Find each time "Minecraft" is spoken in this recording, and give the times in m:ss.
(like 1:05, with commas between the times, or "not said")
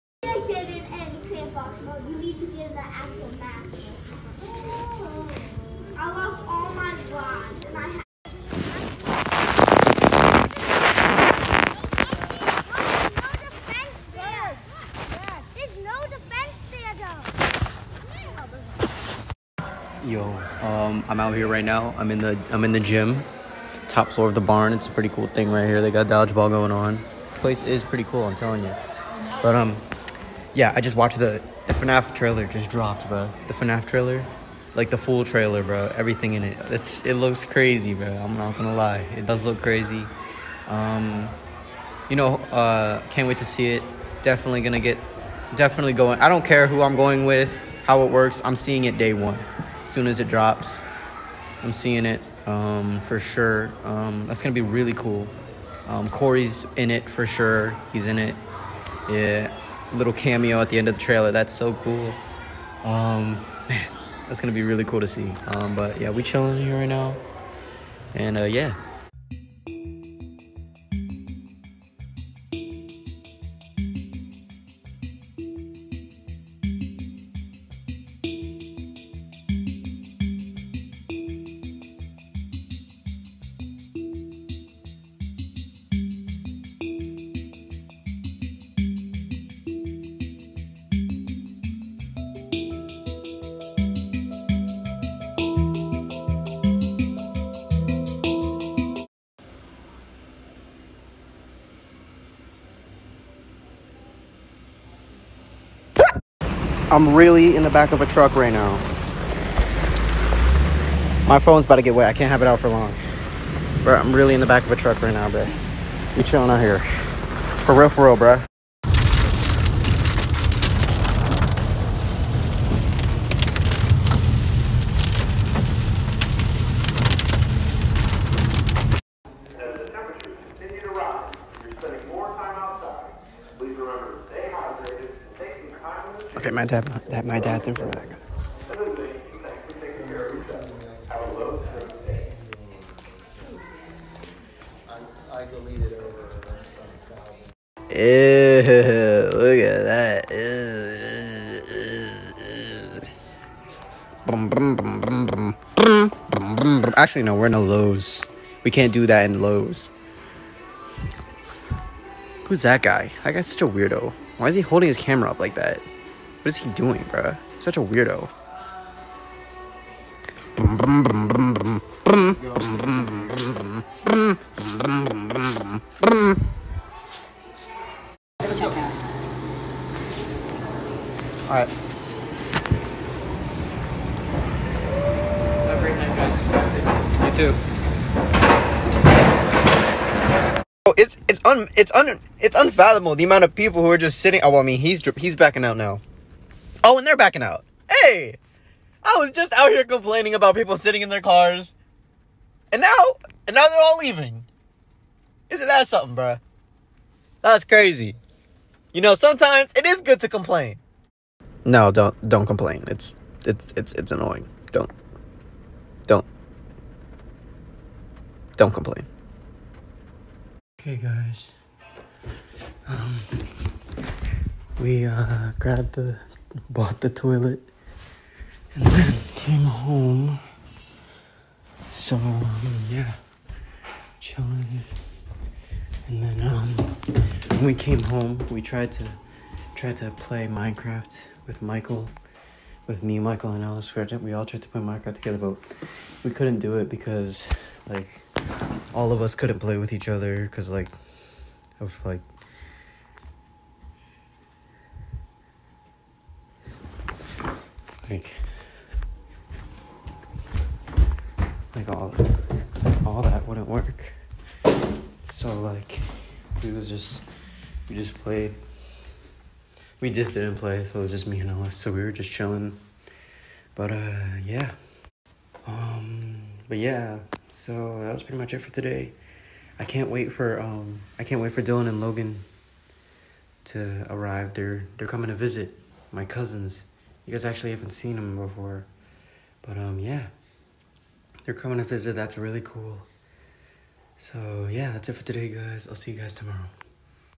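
4:00, 4:04.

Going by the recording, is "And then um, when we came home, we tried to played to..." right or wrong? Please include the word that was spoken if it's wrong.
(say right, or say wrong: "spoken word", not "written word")
wrong: "tried", not "played".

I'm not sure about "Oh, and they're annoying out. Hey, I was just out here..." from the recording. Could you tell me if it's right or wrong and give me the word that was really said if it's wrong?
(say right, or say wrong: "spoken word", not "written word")
wrong: "backing", not "annoying".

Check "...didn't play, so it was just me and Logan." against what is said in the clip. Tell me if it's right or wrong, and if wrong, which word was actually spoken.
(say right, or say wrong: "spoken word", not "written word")
wrong: "Ellis", not "Logan".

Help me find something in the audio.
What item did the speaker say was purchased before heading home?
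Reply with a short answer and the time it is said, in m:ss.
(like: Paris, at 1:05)
Toilet, at 3:47.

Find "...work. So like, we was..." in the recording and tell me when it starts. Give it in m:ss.
4:23.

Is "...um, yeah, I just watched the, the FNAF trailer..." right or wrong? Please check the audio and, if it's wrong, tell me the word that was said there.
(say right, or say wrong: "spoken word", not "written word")
right.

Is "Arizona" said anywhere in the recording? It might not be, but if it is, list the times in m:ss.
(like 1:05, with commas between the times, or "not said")
not said.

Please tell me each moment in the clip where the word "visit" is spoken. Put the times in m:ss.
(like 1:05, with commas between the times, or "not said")
4:45, 4:51.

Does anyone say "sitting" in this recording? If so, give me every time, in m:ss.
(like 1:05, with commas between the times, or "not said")
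3:14, 3:20.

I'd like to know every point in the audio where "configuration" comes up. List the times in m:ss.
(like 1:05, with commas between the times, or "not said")
not said.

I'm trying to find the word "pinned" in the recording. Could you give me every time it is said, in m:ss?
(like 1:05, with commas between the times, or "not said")
not said.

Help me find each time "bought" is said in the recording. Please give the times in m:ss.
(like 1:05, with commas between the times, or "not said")
3:46.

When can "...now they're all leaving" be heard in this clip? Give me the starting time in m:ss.
3:23.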